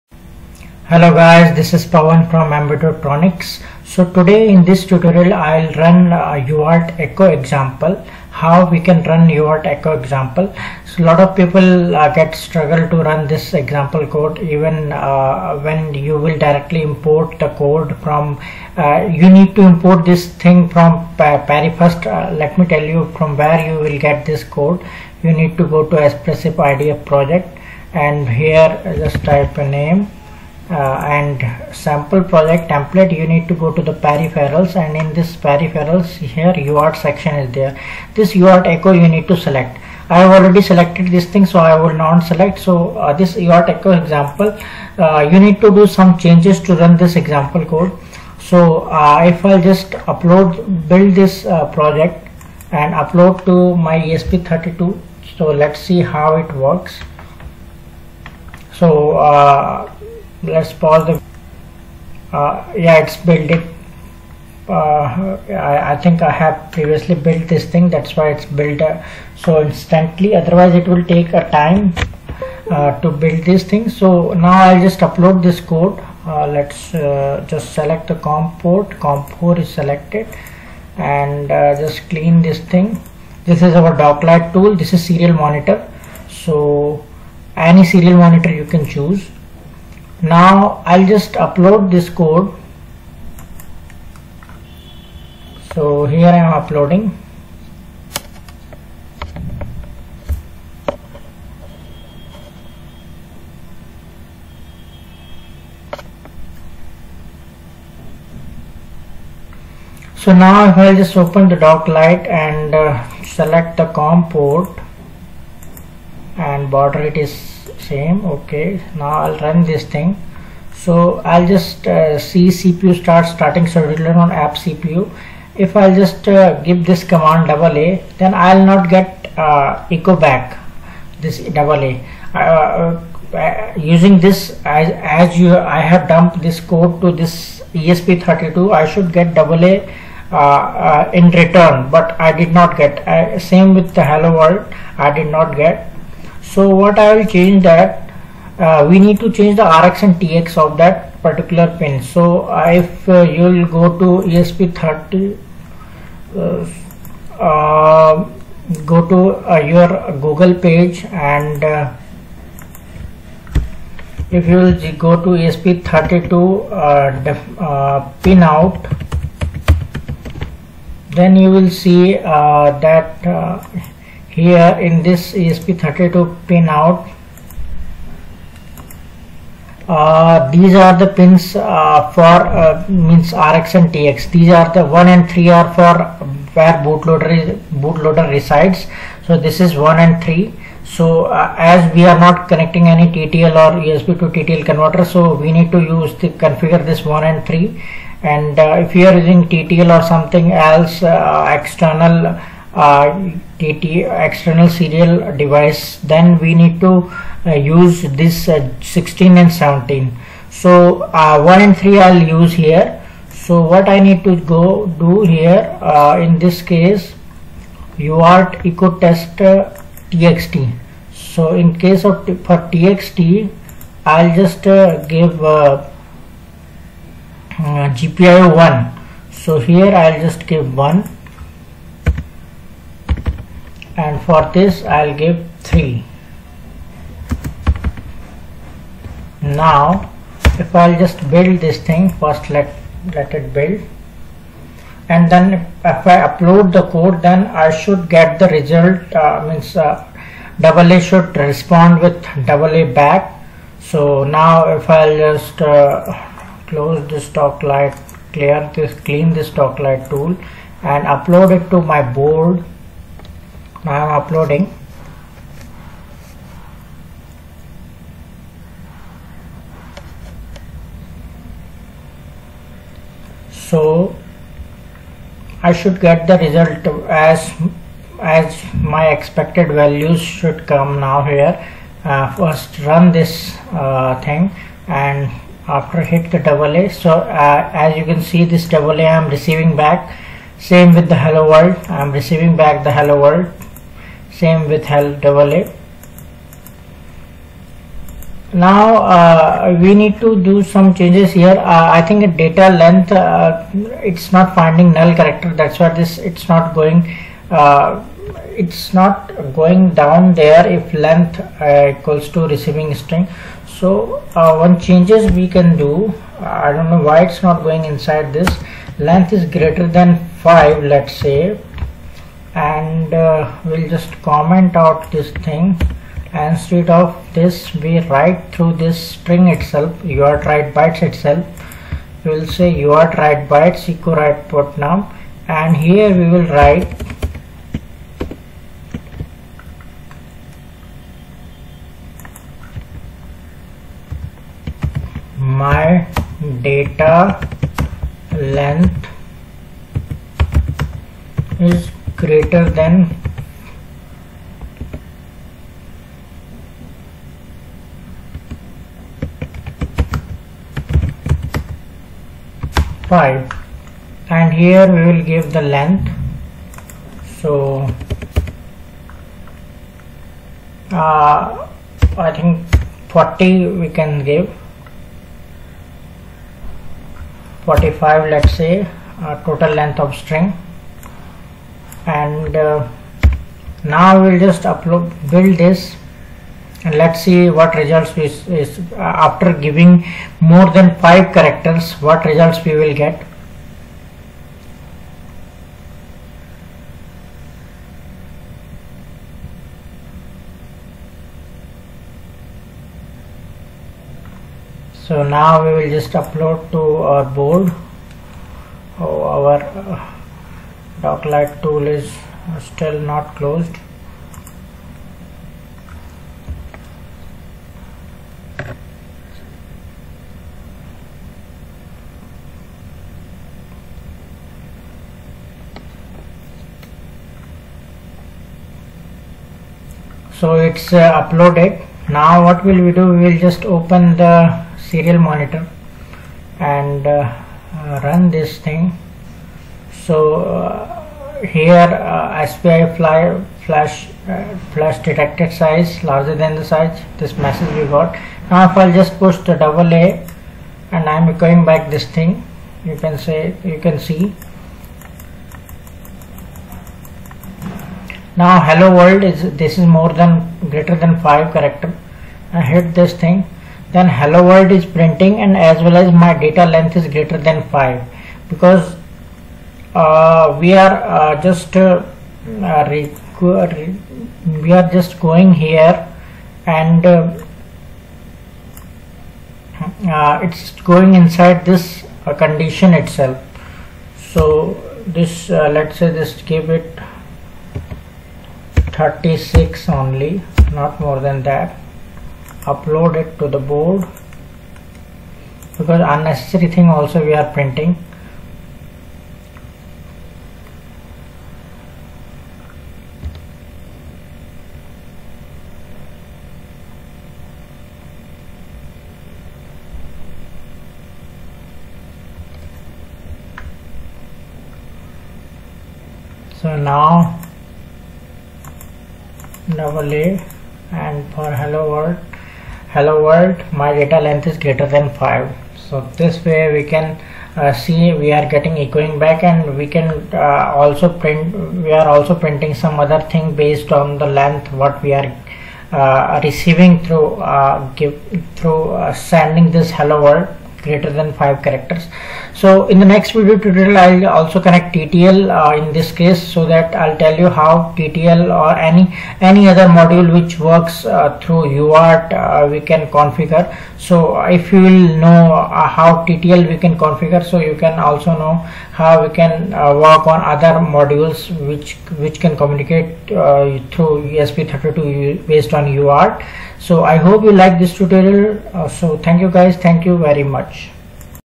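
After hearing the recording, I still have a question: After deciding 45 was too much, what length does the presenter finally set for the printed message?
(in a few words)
36.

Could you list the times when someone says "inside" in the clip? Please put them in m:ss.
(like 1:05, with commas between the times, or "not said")
5:17, 8:01.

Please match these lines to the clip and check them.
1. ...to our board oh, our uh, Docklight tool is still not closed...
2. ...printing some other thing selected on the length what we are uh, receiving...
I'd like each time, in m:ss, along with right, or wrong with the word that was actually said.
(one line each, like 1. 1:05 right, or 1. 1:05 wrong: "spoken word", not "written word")
1. 6:46 right
2. 8:52 wrong: "based", not "selected".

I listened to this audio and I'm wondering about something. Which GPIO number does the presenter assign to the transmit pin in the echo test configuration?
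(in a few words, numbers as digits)
1.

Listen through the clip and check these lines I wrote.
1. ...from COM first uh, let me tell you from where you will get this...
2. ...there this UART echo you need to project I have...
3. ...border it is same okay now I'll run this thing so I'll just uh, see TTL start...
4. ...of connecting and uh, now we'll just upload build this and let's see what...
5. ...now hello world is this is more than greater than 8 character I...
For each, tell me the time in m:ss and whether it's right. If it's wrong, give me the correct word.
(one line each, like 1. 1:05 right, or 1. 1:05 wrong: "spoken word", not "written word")
1. 0:20 wrong: "Parry", not "COM"
2. 0:37 wrong: "select", not "project"
3. 1:56 wrong: "CPU", not "TTL"
4. 6:19 wrong: "string", not "connecting"
5. 7:38 wrong: "5", not "8".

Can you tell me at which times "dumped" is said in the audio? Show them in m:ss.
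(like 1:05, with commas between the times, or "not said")
2:16.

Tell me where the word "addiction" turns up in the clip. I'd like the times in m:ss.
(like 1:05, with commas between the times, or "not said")
not said.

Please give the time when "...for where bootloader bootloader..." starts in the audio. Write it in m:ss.
3:05.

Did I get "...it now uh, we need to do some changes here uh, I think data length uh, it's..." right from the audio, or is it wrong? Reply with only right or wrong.
right.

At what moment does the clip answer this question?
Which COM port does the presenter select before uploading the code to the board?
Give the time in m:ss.
1:18.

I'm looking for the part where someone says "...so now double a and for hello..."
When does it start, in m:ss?
8:36.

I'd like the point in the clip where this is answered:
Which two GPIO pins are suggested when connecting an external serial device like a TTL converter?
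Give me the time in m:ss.
3:28.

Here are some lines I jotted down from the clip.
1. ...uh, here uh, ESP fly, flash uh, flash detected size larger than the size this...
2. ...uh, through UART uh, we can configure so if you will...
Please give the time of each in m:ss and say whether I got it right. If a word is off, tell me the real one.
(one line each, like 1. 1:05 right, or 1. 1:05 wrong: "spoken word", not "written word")
1. 7:20 wrong: "SPI", not "ESP"
2. 9:11 right.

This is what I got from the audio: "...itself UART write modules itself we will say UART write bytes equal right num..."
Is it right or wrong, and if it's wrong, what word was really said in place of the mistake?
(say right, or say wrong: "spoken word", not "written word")
wrong: "bytes", not "modules".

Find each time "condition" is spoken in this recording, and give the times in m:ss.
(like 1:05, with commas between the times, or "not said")
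8:02.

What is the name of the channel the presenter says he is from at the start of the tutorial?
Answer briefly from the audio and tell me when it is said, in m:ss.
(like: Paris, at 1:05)
Embedotronics, at 0:02.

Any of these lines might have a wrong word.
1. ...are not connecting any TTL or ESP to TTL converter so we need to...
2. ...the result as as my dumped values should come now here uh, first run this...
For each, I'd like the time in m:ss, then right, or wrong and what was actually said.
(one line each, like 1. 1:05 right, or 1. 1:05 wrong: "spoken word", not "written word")
1. 3:12 right
2. 4:36 wrong: "expected", not "dumped".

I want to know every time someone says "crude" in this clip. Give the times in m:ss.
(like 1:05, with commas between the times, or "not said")
not said.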